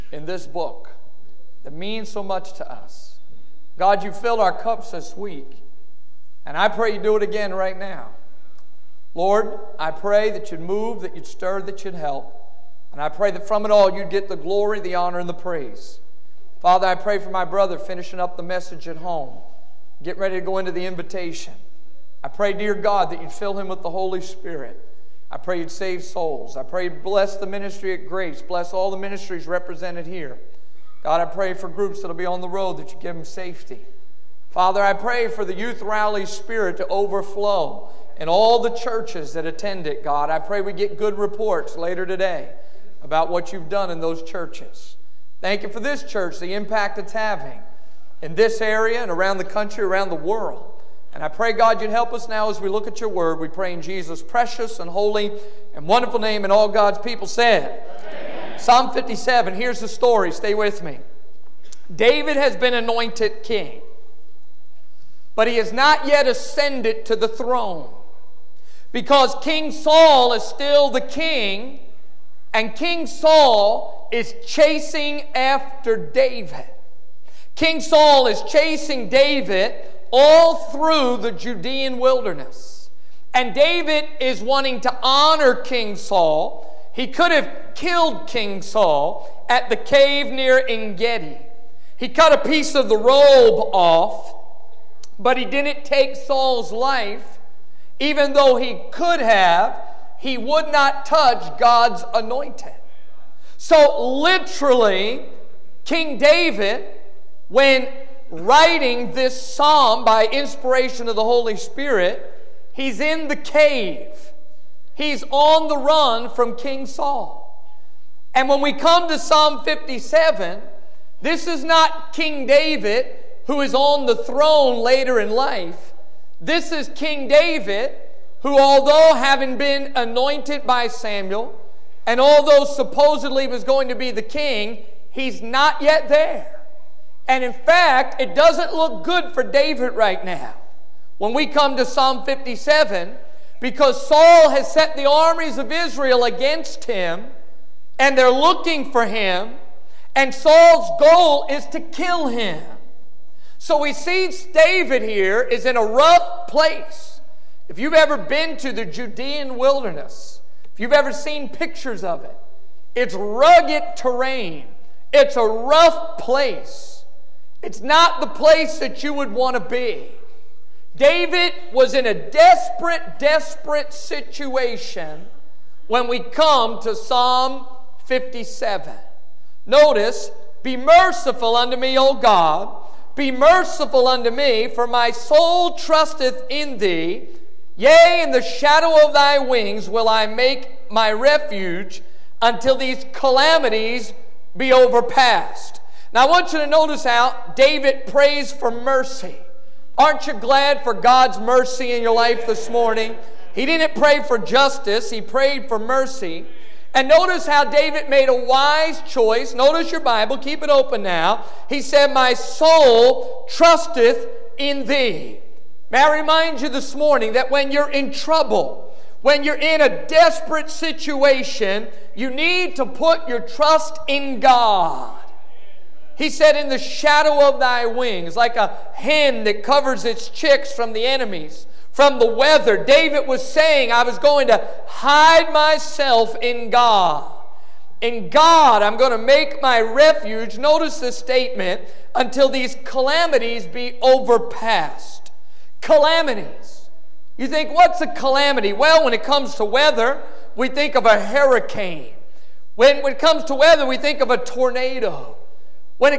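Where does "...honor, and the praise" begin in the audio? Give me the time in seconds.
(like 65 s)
14 s.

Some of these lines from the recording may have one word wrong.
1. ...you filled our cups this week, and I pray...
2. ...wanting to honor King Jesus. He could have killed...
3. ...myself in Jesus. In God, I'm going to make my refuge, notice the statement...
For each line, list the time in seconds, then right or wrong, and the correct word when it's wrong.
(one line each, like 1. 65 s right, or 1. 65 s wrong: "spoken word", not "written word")
1. 4 s right
2. 84 s wrong: "Saul", not "Jesus"
3. 235 s wrong: "God", not "Jesus".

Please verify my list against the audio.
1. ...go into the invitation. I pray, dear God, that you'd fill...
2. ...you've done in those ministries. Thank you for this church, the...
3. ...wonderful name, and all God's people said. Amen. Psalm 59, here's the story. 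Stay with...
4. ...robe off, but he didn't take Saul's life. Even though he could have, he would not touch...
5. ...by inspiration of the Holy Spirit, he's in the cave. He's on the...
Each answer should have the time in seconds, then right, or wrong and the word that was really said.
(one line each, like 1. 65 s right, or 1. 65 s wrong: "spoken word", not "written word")
1. 20 s right
2. 43 s wrong: "churches", not "ministries"
3. 55 s wrong: "57", not "59"
4. 92 s right
5. 110 s right.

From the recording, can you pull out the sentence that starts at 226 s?
He said, In the shadow of thy wings, like a hen that covers its chicks from the enemies, from the weather.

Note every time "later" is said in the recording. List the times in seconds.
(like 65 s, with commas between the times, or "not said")
41 s, 124 s.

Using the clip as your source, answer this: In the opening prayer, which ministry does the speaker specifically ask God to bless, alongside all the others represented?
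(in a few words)
Grace.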